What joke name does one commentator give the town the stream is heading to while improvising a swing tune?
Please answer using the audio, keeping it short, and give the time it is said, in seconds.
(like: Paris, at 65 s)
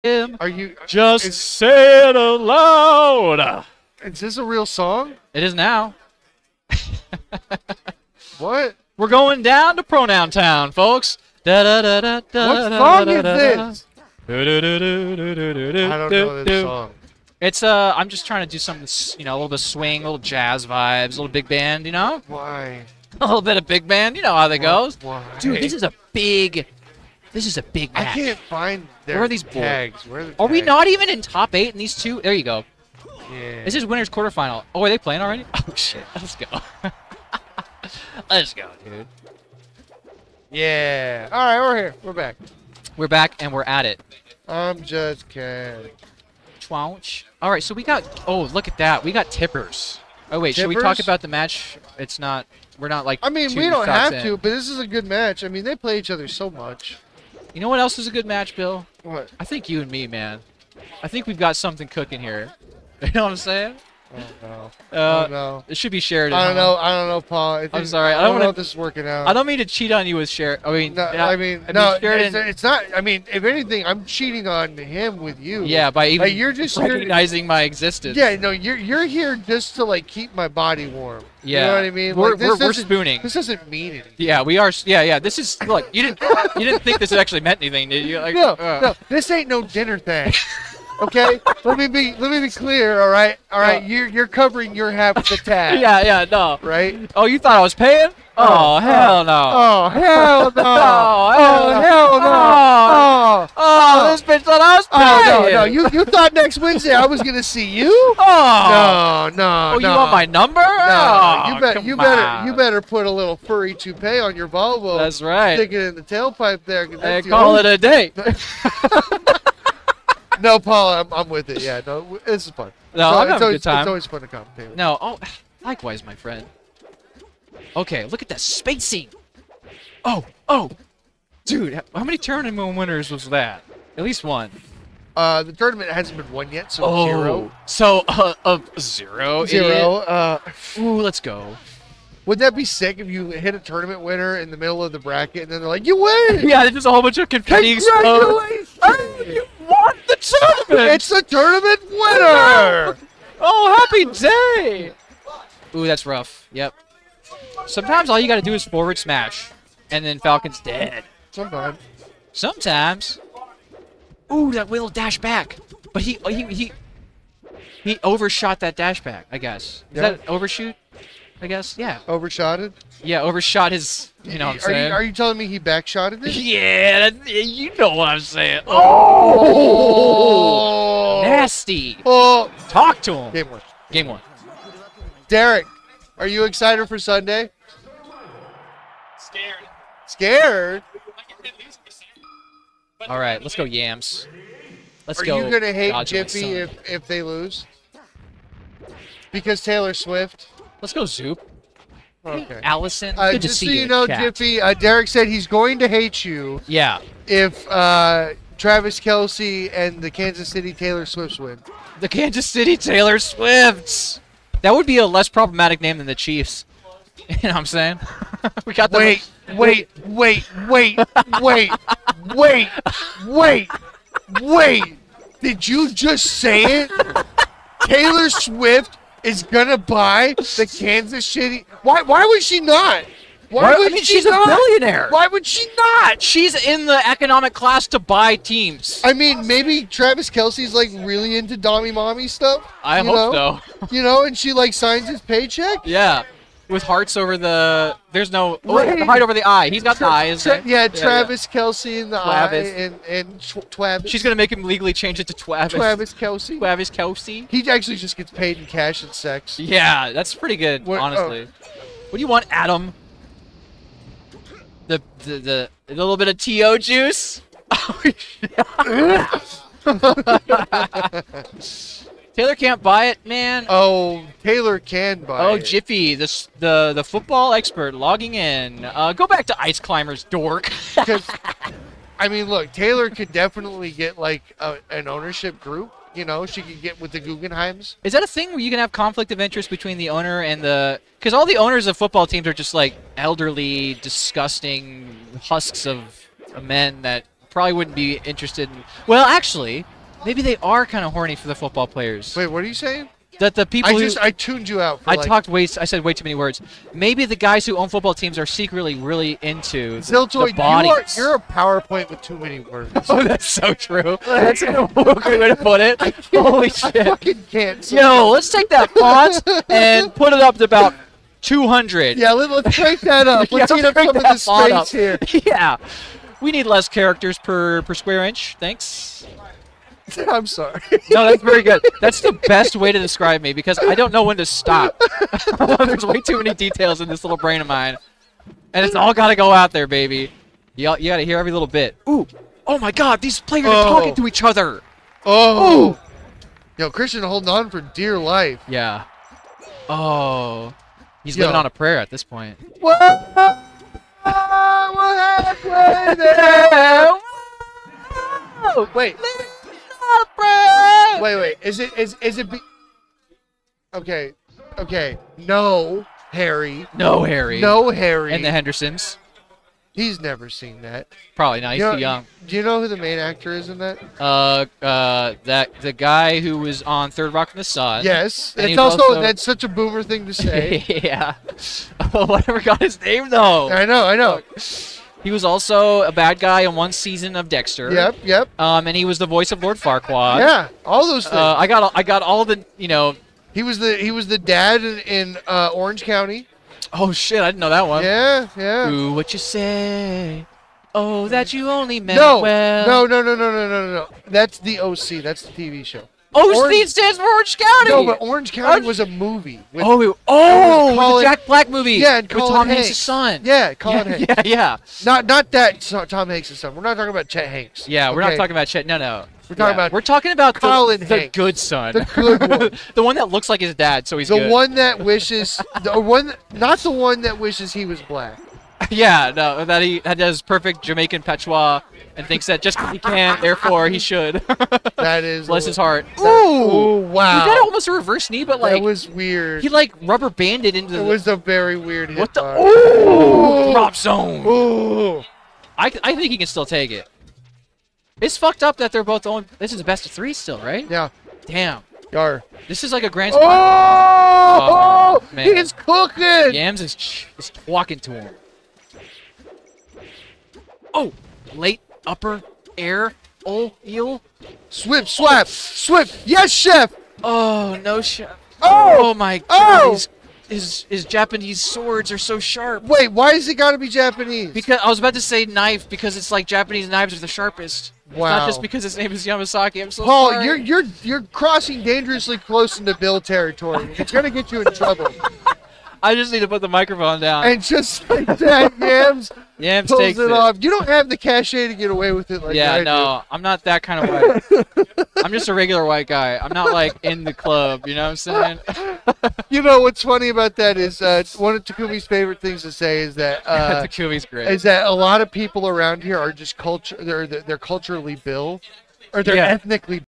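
Pronoun Town, at 9 s.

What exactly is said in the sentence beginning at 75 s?
Yeah, by even like, you're just recognizing my existence.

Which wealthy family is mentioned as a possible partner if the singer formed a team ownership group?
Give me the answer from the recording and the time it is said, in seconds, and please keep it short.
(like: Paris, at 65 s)
The Guggenheims, at 287 s.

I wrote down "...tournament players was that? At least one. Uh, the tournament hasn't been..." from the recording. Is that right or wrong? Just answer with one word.
wrong.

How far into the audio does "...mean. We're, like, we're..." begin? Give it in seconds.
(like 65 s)
81 s.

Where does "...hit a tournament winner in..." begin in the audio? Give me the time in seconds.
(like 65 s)
143 s.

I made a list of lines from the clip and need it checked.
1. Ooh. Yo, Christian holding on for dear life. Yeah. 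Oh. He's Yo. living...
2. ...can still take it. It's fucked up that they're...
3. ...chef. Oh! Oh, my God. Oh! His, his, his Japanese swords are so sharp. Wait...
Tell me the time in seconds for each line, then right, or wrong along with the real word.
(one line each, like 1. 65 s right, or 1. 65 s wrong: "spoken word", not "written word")
1. 345 s right
2. 446 s right
3. 468 s right.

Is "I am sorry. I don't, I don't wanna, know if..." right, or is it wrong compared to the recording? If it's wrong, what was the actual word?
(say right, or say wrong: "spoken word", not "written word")
right.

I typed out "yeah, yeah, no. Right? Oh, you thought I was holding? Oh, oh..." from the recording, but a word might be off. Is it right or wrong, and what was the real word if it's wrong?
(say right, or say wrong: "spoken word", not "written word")
wrong: "paying", not "holding".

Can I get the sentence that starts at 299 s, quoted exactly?
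Well, actually maybe they are kind of horny for the football players.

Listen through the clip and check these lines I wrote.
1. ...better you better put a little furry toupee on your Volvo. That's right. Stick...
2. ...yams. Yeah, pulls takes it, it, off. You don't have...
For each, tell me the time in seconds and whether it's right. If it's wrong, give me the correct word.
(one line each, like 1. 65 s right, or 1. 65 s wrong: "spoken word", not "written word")
1. 111 s right
2. 488 s right.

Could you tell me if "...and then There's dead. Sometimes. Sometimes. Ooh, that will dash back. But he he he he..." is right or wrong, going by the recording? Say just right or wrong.
wrong.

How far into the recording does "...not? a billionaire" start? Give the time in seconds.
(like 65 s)
234 s.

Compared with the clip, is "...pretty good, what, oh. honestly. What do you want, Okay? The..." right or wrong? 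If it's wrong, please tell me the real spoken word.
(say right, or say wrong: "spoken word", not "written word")
wrong: "Adam", not "Okay".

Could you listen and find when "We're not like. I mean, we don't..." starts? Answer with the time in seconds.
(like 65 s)
52 s.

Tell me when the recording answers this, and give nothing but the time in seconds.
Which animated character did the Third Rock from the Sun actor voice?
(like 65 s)
389 s.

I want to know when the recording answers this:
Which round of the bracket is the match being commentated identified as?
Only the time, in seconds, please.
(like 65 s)
33 s.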